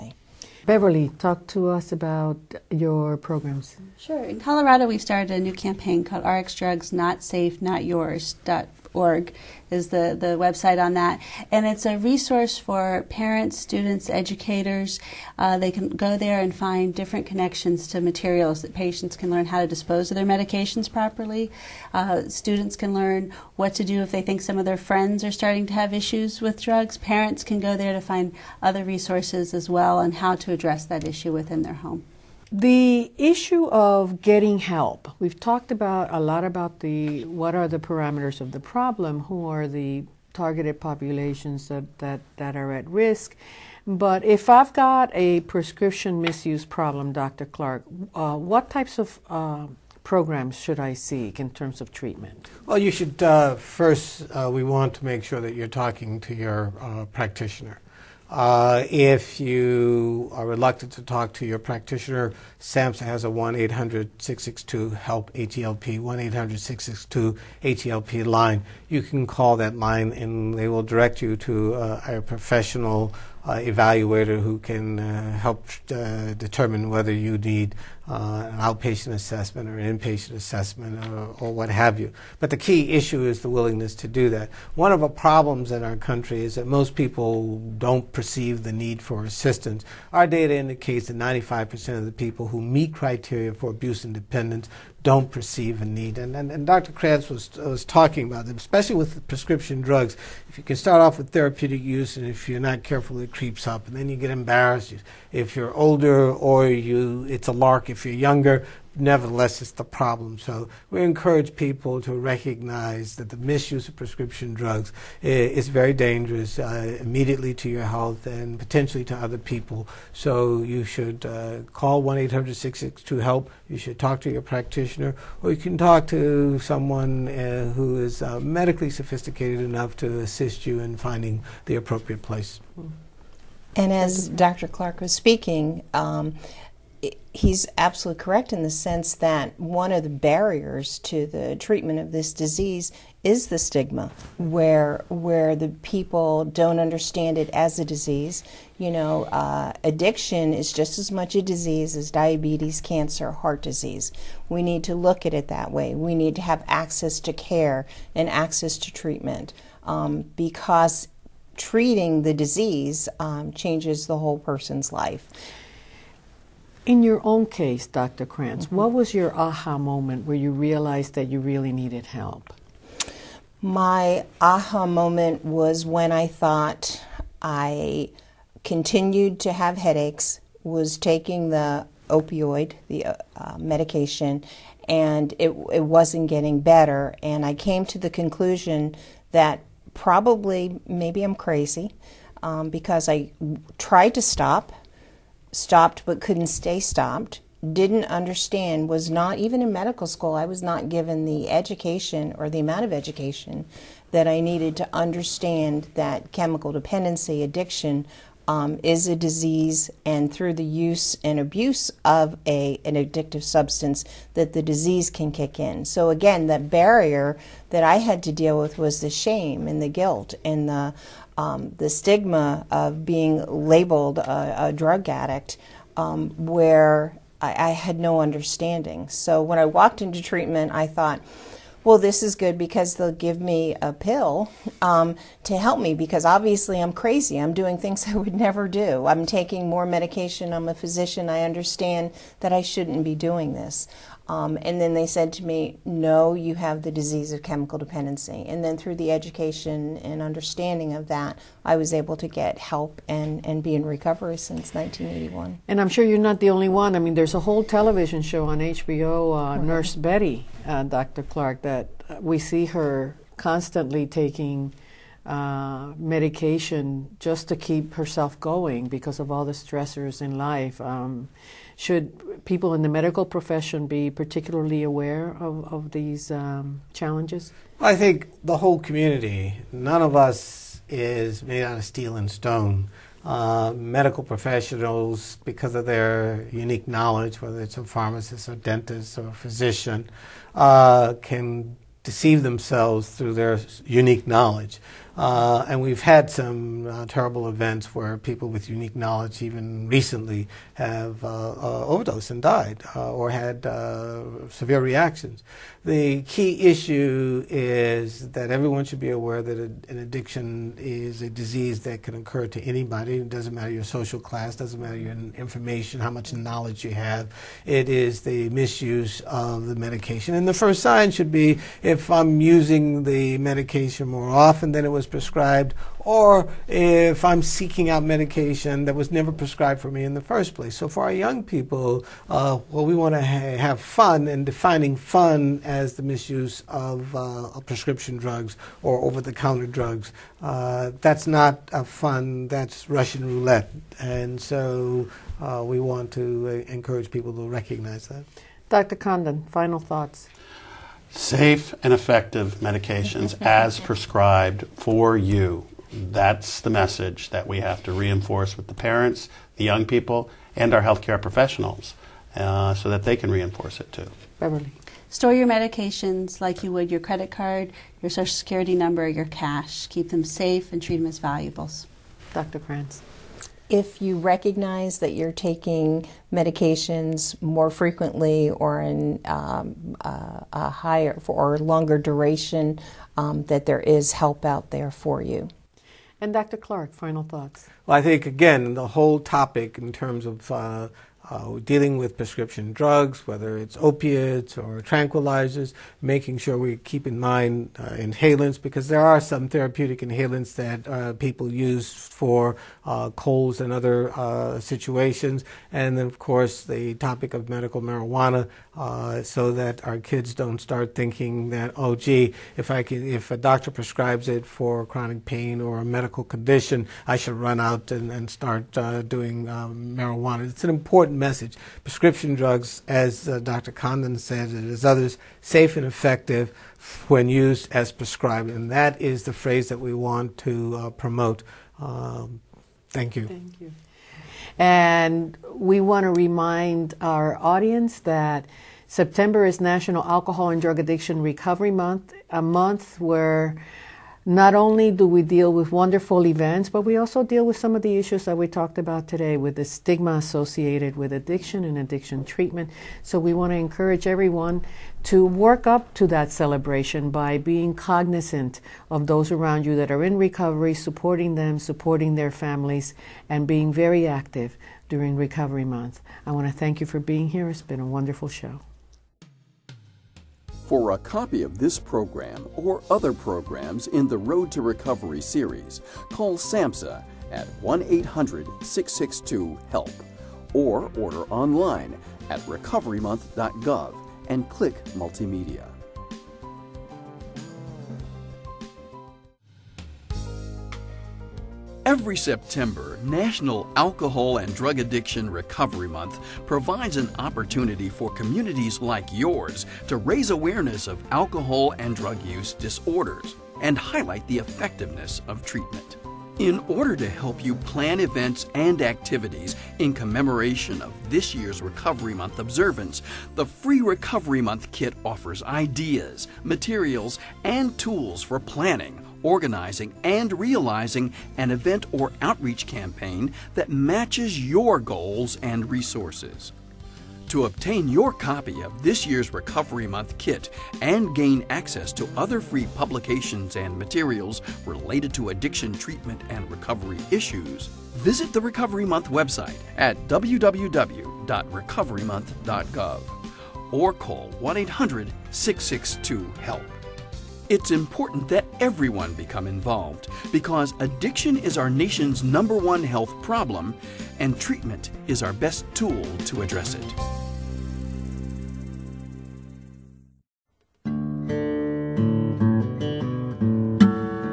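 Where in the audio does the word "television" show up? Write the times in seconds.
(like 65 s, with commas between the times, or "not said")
257 s.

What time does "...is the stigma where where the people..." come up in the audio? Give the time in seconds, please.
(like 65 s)
143 s.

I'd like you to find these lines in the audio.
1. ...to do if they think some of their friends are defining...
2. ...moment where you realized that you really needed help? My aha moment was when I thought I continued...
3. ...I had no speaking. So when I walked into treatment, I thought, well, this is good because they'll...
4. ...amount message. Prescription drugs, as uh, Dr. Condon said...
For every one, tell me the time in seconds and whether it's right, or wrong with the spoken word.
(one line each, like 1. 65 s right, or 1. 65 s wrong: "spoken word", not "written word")
1. 23 s wrong: "starting", not "defining"
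2. 169 s right
3. 227 s wrong: "understanding", not "speaking"
4. 421 s wrong: "important", not "amount".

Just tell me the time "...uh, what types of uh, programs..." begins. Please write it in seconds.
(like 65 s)
48 s.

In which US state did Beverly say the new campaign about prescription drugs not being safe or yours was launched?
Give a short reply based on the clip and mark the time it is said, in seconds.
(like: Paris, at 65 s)
Colorado, at 4 s.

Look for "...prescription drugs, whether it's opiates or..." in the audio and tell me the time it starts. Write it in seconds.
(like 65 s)
392 s.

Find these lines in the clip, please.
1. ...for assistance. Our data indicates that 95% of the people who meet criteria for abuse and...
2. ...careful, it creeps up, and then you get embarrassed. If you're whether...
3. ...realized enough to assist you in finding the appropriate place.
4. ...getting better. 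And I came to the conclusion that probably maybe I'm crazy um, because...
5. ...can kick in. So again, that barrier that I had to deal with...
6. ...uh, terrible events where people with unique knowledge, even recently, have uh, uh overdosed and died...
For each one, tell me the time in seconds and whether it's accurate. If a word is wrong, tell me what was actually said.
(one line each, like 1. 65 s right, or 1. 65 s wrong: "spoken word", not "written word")
1. 88 s right
2. 102 s wrong: "older", not "whether"
3. 128 s wrong: "sophisticated", not "realized"
4. 186 s right
5. 215 s right
6. 296 s right.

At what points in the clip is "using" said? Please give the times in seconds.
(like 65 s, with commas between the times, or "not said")
322 s.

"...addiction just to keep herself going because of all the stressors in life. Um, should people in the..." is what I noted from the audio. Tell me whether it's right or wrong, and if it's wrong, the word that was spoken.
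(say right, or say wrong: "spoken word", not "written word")
wrong: "medication", not "addiction".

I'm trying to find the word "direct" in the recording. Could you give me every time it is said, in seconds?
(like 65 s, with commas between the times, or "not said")
70 s.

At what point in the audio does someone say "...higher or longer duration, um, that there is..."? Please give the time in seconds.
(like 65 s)
380 s.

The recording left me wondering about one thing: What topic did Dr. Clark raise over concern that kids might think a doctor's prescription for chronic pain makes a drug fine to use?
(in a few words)
Medical marijuana.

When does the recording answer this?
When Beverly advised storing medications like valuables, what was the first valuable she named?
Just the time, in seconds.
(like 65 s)
366 s.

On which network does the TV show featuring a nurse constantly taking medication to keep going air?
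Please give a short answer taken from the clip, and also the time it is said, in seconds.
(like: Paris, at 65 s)
HBO, at 258 s.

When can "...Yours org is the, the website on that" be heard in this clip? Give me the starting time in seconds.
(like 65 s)
7 s.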